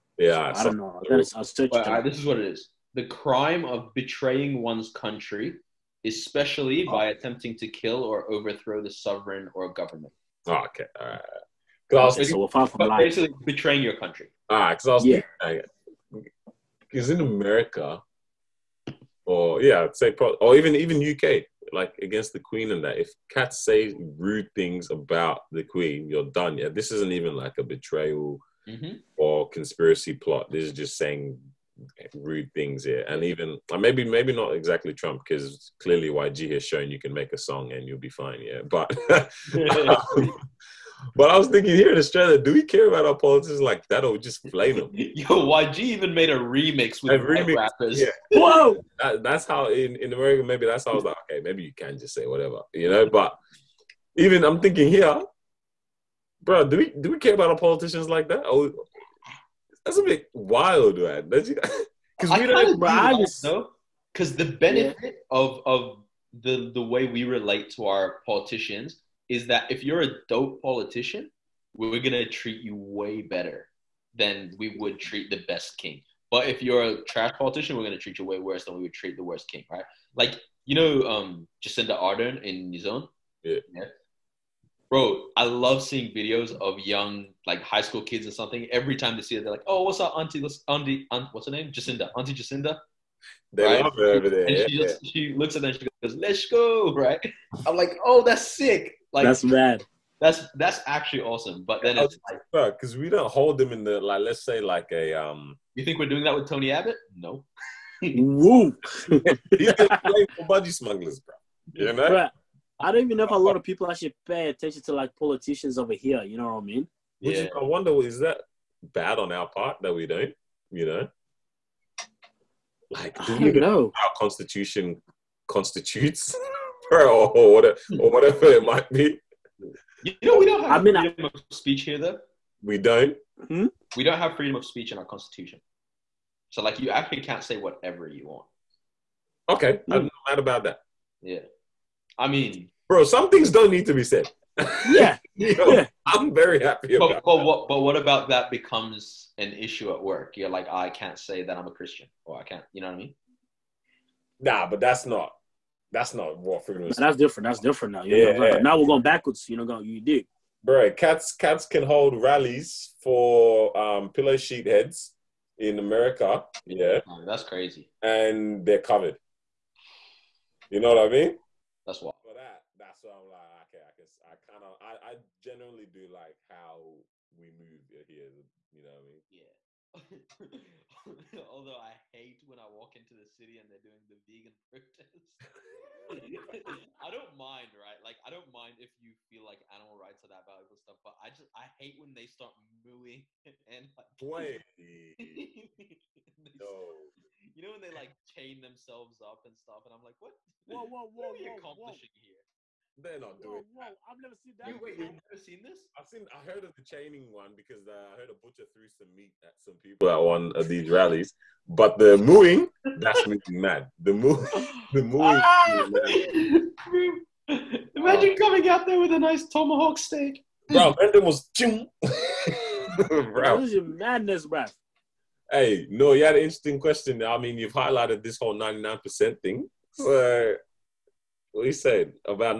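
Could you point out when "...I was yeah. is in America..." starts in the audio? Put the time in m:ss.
0:14.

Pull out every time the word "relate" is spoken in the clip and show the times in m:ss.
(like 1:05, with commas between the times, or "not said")
1:07.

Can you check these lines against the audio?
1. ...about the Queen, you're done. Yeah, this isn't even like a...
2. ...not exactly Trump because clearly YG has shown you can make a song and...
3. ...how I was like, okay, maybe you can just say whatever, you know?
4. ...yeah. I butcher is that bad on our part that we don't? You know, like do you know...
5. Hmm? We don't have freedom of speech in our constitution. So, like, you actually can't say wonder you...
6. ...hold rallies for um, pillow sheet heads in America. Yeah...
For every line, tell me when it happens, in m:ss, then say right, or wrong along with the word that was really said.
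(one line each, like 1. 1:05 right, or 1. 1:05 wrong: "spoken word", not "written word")
1. 0:24 right
2. 0:34 right
3. 0:50 right
4. 1:57 wrong: "wonder", not "butcher"
5. 2:13 wrong: "whatever", not "wonder"
6. 2:41 right.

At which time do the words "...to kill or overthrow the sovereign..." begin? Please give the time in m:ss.
0:07.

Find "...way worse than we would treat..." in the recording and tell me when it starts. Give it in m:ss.
1:18.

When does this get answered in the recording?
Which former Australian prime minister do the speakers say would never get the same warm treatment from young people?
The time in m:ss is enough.
1:46.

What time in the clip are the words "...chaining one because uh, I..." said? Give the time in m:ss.
3:26.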